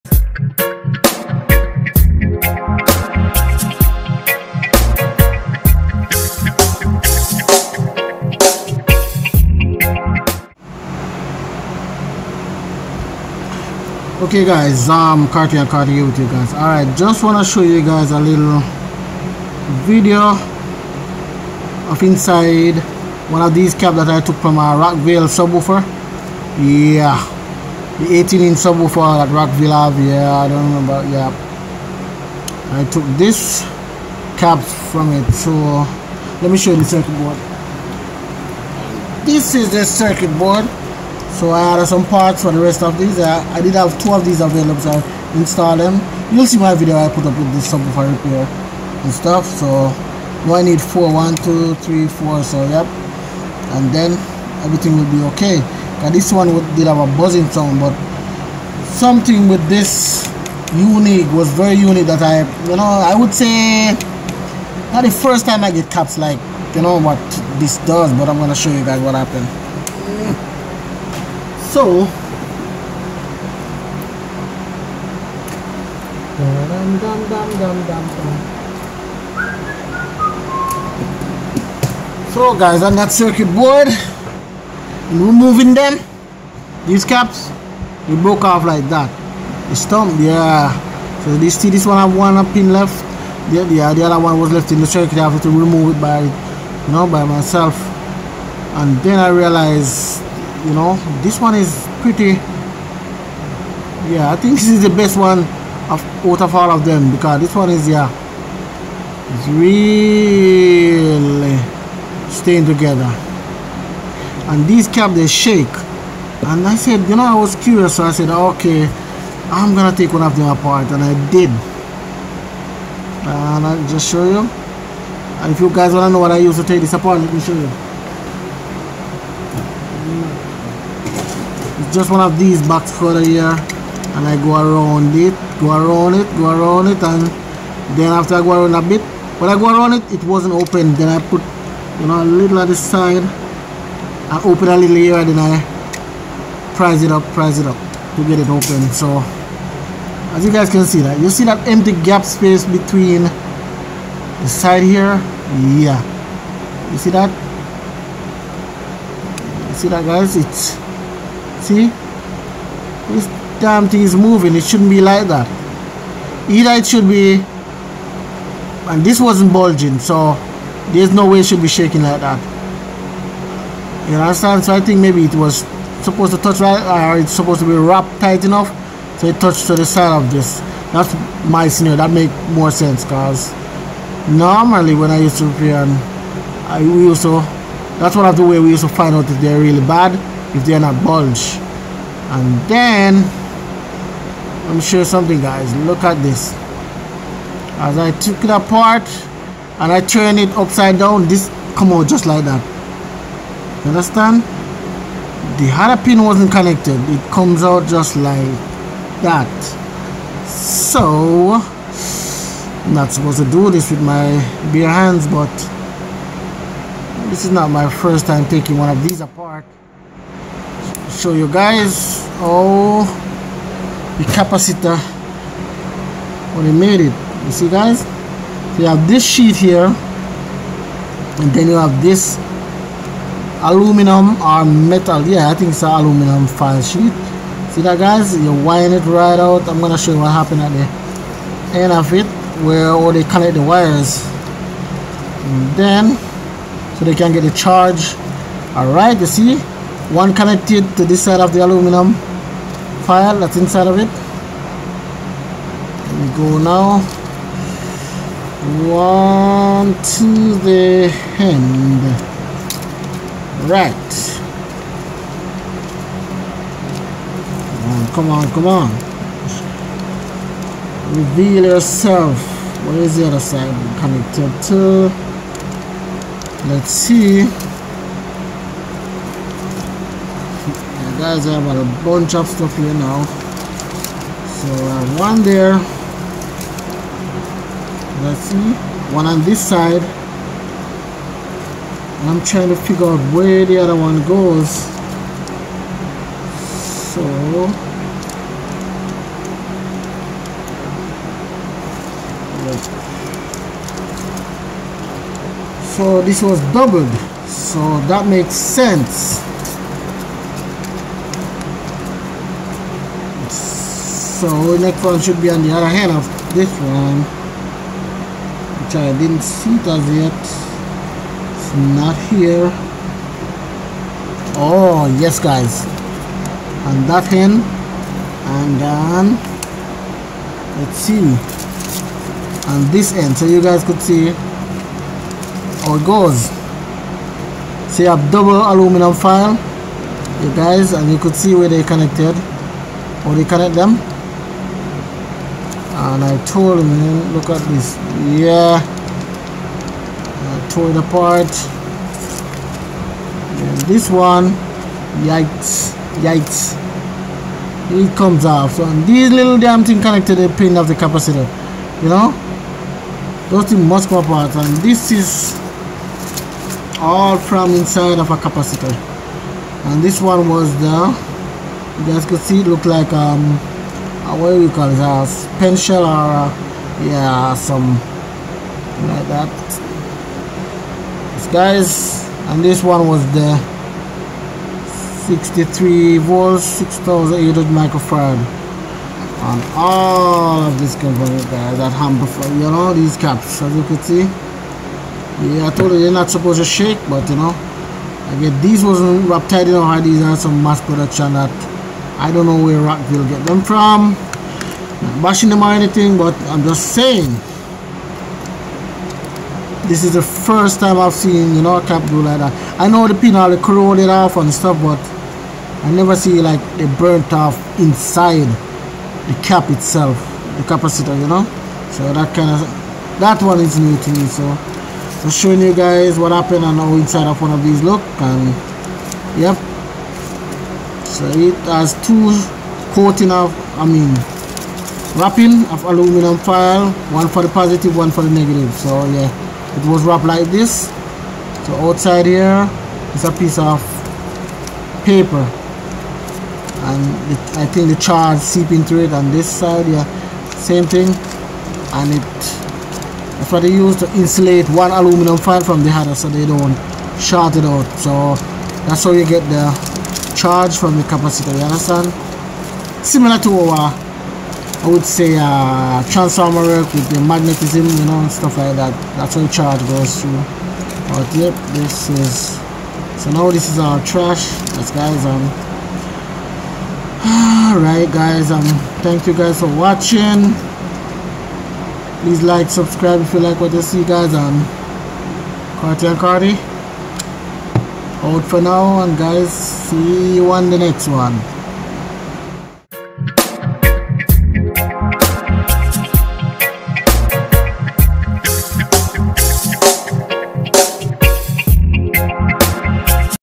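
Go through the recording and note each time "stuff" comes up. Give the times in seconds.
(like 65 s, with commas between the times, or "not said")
49 s, 282 s, 414 s, 468 s.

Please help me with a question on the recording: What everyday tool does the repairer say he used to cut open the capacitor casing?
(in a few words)
box cutter.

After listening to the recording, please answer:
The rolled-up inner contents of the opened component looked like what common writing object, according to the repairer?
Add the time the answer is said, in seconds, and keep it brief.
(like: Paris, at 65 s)
a pencil, at 374 s.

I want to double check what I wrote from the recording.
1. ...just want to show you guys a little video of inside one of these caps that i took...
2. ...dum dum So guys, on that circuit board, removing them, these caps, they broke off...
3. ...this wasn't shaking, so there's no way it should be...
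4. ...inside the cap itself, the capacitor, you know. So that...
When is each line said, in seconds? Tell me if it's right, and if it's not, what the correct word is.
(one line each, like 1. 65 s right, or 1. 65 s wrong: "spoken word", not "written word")
1. 16 s right
2. 77 s right
3. 169 s wrong: "bulging", not "shaking"
4. 417 s right.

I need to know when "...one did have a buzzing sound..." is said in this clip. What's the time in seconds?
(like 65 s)
56 s.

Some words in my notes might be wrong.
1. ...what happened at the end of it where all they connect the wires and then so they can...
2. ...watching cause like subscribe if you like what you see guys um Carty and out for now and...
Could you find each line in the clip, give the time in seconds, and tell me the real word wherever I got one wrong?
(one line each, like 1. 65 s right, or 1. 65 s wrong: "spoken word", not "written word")
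1. 240 s right
2. 479 s wrong: "please", not "cause".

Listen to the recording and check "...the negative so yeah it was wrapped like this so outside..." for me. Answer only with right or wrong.
right.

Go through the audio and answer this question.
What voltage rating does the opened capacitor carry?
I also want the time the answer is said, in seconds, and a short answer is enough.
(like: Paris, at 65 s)
63 volts, at 385 s.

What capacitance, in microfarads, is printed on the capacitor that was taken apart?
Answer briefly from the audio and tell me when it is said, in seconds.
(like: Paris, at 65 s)
6800 microfarad, at 386 s.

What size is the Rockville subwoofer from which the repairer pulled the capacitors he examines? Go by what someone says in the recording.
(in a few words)
18 inch.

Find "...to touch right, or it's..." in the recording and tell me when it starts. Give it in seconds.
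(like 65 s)
176 s.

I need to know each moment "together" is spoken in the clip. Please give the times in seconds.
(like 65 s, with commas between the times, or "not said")
112 s.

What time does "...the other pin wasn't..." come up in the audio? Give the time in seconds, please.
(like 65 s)
205 s.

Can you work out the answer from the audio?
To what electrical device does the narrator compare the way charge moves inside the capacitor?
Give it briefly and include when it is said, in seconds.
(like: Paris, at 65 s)
transformer, at 466 s.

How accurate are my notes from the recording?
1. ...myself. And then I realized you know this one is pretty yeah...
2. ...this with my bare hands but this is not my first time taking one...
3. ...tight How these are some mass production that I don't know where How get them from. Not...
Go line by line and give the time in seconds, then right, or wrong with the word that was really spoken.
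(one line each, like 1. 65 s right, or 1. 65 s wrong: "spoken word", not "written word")
1. 97 s right
2. 213 s right
3. 399 s wrong: "Rockville", not "How".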